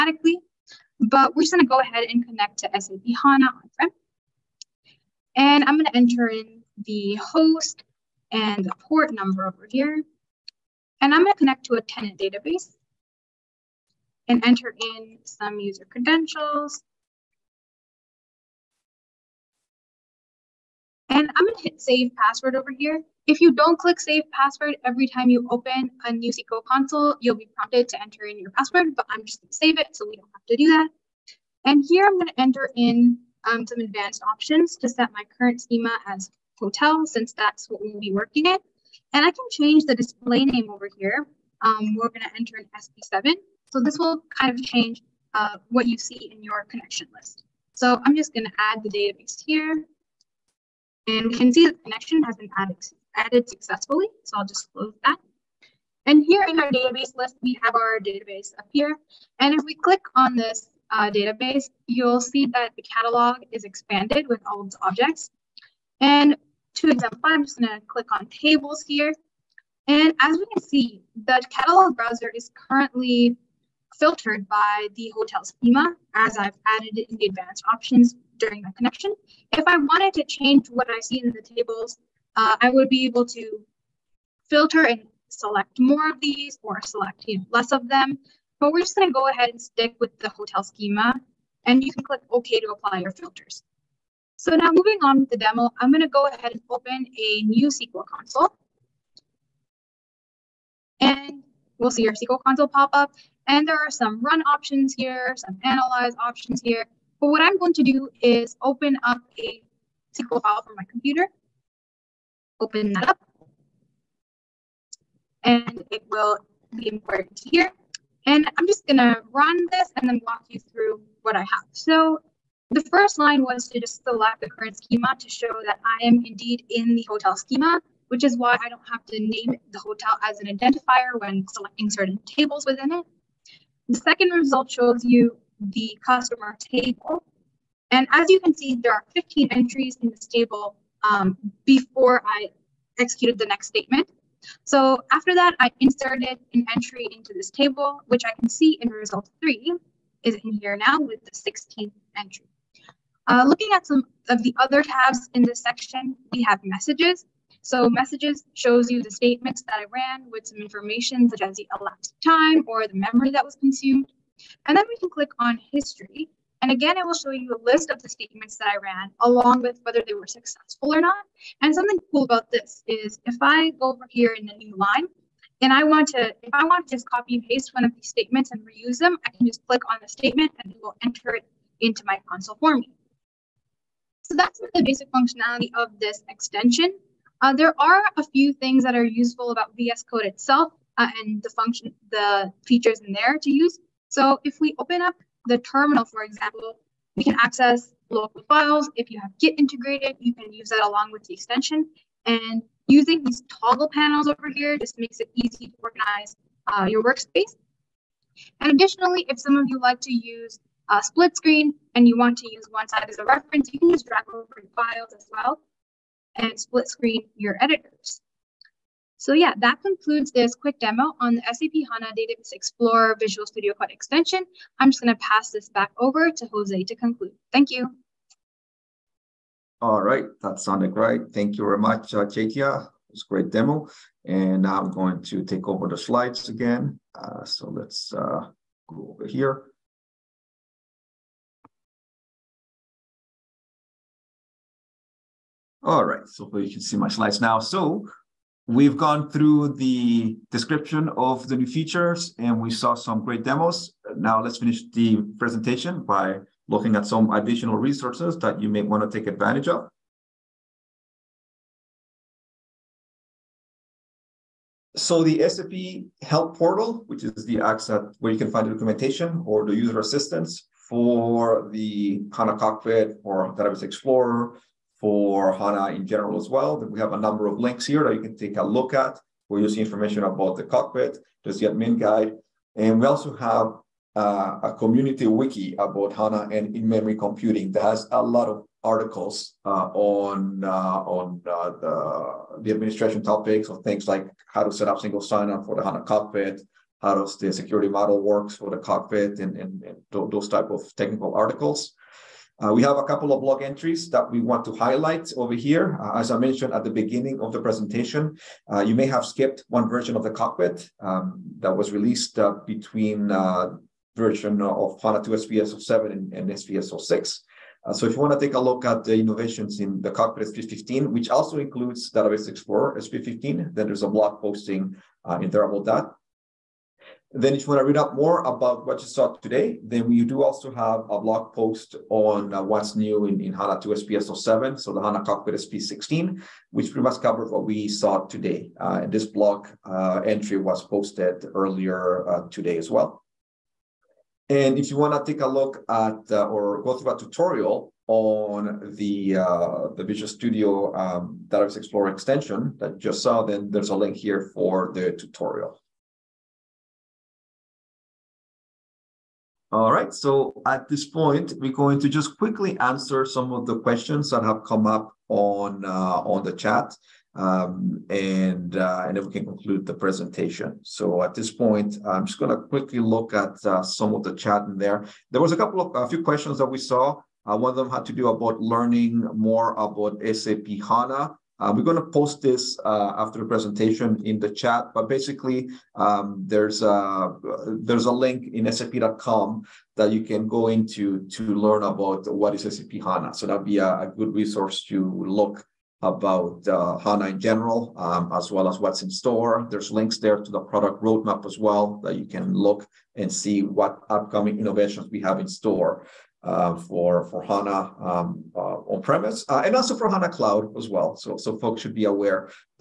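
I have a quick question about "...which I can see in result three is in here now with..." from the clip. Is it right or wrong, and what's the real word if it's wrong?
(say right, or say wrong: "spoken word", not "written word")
right.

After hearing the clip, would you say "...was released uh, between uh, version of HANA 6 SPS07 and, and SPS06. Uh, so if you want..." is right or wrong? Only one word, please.
wrong.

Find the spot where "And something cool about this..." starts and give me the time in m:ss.
2:51.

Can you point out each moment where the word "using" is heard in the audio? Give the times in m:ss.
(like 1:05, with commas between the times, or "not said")
3:22, 4:39.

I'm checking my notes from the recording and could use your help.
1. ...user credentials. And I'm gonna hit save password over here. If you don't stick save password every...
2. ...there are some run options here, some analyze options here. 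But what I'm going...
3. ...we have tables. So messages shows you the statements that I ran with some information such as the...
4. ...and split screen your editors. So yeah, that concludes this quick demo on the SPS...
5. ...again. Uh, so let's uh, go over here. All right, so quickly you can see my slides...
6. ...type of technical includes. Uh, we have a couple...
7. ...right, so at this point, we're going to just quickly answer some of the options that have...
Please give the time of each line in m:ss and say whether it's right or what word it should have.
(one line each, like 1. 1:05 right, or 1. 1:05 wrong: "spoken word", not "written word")
1. 0:15 wrong: "click", not "stick"
2. 1:43 right
3. 2:36 wrong: "messages", not "tables"
4. 3:36 wrong: "SAP", not "SPS"
5. 3:56 wrong: "hopefully", not "quickly"
6. 5:00 wrong: "articles", not "includes"
7. 5:59 wrong: "questions", not "options".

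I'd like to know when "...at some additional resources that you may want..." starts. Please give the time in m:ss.
4:16.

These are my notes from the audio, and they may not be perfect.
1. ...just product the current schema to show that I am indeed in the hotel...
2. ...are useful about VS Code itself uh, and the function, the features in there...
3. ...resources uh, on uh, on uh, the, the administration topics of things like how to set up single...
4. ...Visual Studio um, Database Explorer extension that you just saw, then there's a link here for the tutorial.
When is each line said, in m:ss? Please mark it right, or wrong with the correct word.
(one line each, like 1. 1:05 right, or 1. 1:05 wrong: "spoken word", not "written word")
1. 2:03 wrong: "select", not "product"
2. 3:08 right
3. 4:48 wrong: "articles", not "resources"
4. 5:50 right.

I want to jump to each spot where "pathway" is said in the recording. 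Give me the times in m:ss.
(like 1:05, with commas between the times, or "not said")
not said.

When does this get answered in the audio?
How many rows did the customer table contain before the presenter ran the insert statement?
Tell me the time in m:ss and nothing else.
2:19.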